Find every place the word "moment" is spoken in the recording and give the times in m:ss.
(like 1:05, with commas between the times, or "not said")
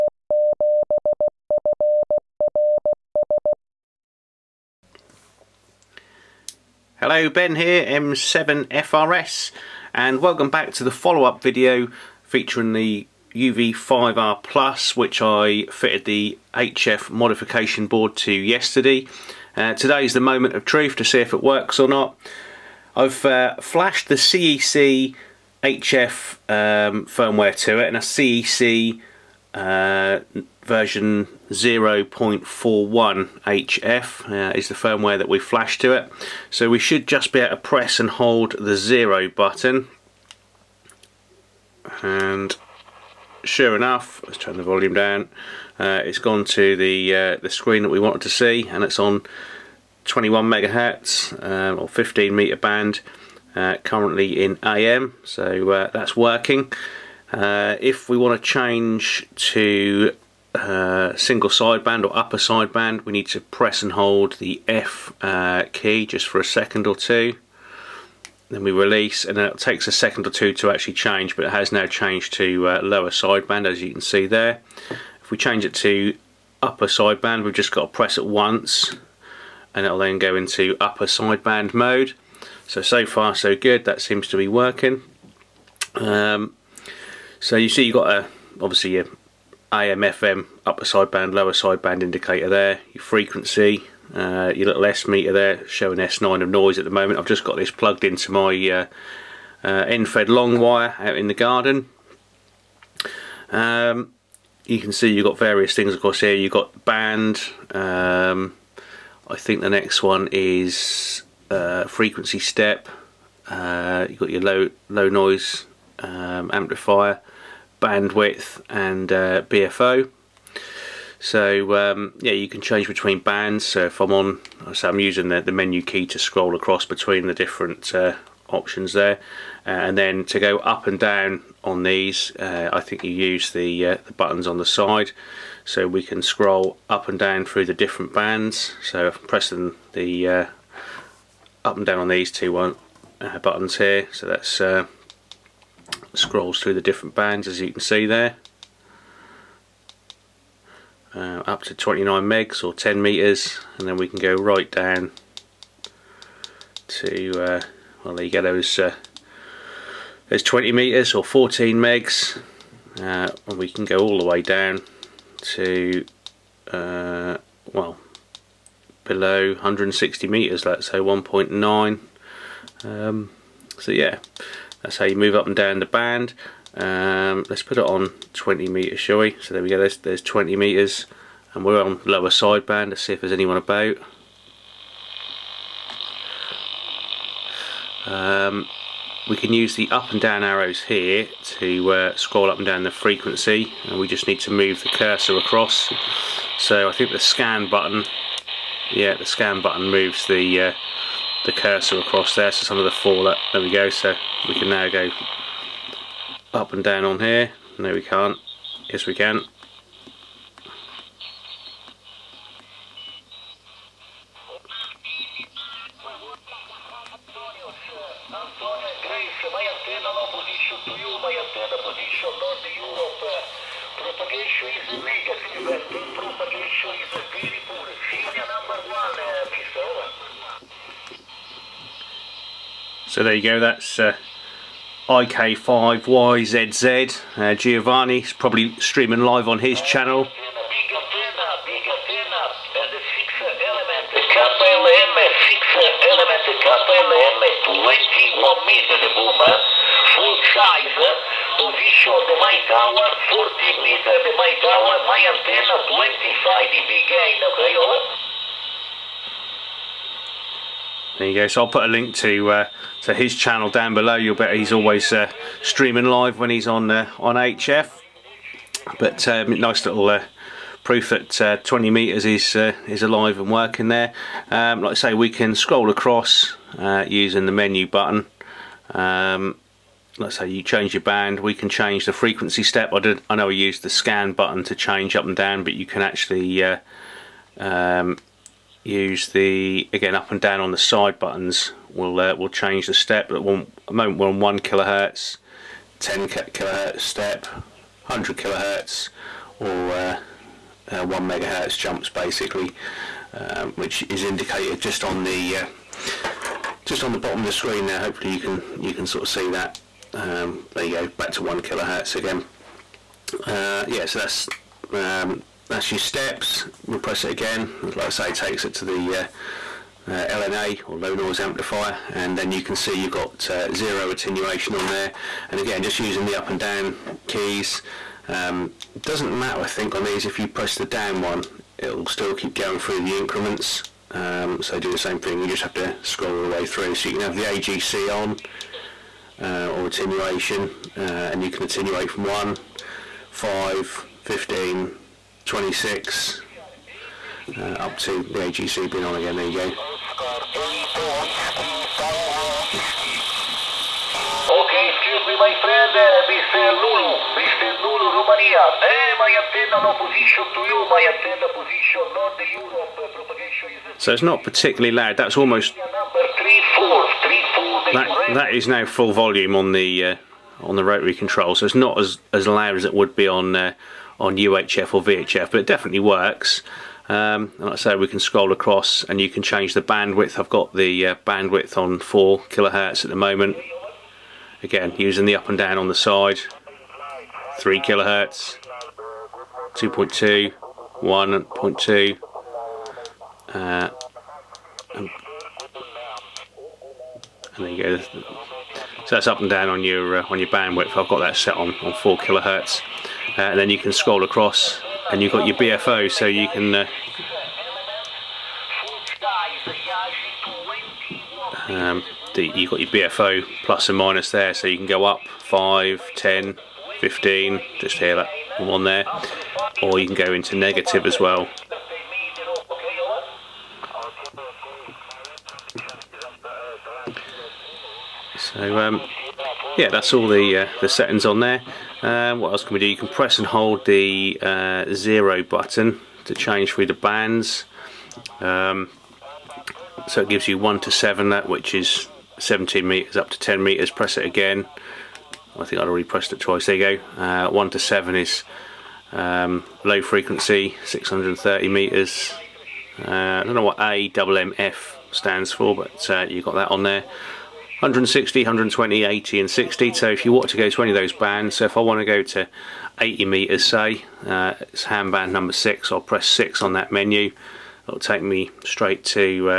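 0:20, 1:36, 4:53, 6:23.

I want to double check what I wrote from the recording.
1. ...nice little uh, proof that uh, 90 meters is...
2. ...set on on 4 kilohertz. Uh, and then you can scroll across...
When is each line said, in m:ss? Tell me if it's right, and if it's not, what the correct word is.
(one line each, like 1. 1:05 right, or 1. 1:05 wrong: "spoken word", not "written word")
1. 4:29 wrong: "20", not "90"
2. 6:41 right.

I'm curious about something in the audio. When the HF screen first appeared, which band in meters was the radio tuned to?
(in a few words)
15 meter.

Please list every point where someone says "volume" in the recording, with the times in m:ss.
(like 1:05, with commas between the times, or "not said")
0:44, 6:09.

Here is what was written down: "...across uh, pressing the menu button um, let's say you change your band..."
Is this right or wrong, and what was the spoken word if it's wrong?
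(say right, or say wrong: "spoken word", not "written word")
wrong: "using", not "pressing".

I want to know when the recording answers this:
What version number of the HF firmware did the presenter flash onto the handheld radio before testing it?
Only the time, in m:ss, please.
0:30.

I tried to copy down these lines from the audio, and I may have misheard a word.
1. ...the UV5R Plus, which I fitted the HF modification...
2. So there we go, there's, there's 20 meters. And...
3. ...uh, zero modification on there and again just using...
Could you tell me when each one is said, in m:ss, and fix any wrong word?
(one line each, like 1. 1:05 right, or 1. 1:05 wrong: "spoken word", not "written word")
1. 0:12 right
2. 2:59 right
3. 5:23 wrong: "attenuation", not "modification".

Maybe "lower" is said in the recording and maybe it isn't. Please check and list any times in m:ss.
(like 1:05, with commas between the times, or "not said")
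1:12, 1:31, 3:02.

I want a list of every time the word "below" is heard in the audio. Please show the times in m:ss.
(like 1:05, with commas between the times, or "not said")
2:49, 4:23.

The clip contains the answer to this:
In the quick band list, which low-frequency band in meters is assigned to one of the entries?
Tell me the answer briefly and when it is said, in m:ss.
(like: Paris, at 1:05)
630 meters, at 7:30.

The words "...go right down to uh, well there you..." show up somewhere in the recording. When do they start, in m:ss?
2:34.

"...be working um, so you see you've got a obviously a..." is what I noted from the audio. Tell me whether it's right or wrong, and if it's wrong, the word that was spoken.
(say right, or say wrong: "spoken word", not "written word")
right.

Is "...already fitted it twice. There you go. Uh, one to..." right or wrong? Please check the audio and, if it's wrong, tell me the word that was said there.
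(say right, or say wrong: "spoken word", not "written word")
wrong: "pressed", not "fitted".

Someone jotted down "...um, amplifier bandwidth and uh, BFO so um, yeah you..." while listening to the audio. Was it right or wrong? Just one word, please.
right.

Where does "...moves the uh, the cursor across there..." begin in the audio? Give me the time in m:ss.
3:19.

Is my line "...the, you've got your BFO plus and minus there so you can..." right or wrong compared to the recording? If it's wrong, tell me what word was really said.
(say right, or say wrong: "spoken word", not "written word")
right.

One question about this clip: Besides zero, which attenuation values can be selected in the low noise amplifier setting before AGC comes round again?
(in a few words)
1, 5, 15, 26.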